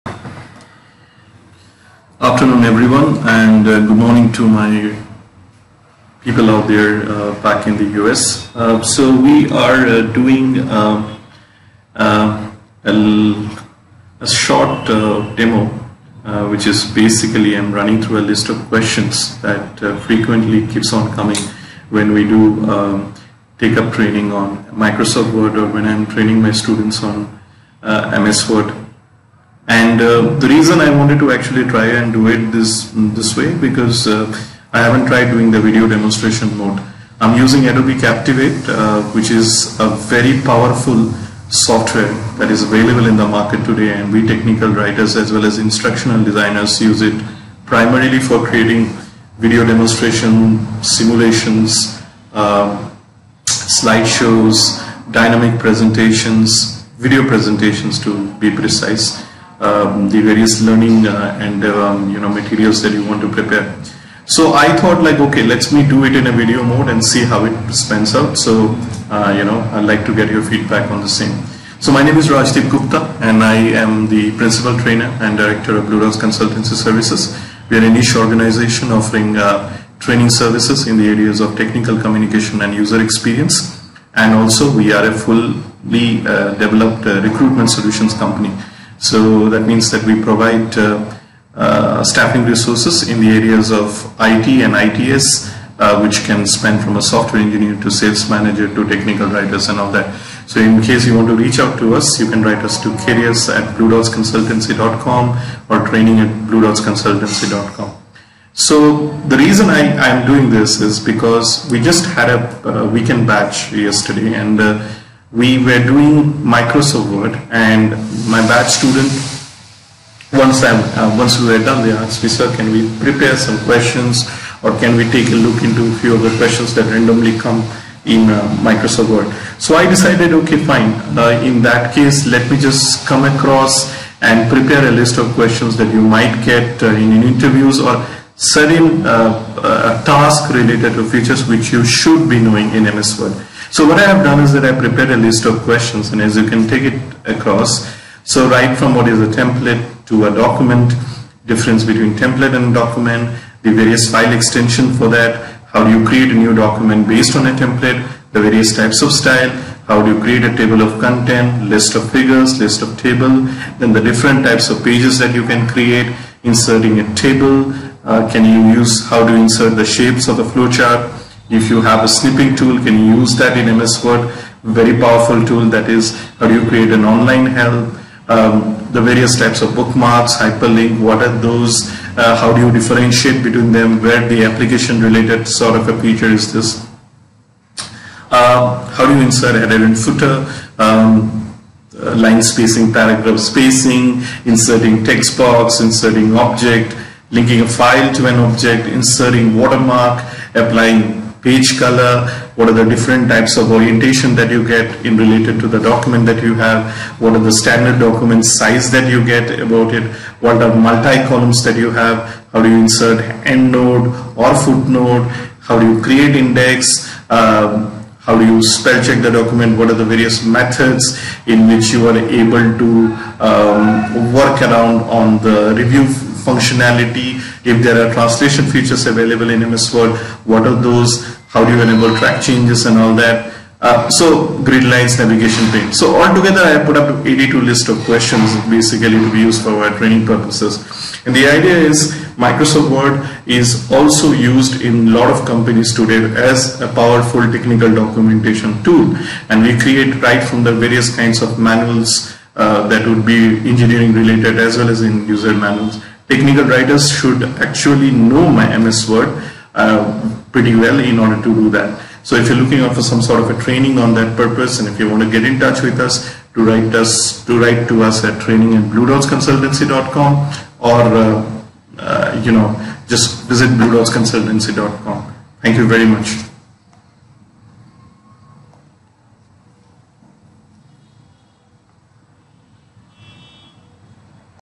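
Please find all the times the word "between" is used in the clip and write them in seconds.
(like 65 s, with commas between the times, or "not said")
151 s, 183 s.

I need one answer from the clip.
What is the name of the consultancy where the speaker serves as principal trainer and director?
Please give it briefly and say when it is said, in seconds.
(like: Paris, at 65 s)
Blue Dots Consultancy Services, at 75 s.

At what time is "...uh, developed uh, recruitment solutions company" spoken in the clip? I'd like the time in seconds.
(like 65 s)
86 s.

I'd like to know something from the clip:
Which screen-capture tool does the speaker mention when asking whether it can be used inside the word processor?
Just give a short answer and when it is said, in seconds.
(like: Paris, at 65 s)
snipping tool, at 172 s.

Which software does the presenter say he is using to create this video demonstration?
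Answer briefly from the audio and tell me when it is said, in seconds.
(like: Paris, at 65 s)
Adobe Captivate, at 37 s.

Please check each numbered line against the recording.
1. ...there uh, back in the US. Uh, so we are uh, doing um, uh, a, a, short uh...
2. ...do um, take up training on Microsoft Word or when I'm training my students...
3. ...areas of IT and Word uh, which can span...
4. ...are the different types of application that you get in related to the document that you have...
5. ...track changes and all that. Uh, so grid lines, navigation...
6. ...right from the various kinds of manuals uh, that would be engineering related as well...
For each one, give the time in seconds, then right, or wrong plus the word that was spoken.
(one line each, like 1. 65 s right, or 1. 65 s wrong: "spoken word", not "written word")
1. 6 s right
2. 22 s right
3. 93 s wrong: "ITS", not "Word"
4. 202 s wrong: "orientation", not "application"
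5. 232 s right
6. 250 s right.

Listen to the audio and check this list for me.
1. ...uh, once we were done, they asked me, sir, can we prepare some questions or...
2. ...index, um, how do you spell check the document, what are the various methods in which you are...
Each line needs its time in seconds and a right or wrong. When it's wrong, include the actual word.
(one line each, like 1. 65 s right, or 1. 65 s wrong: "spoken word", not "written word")
1. 120 s right
2. 216 s right.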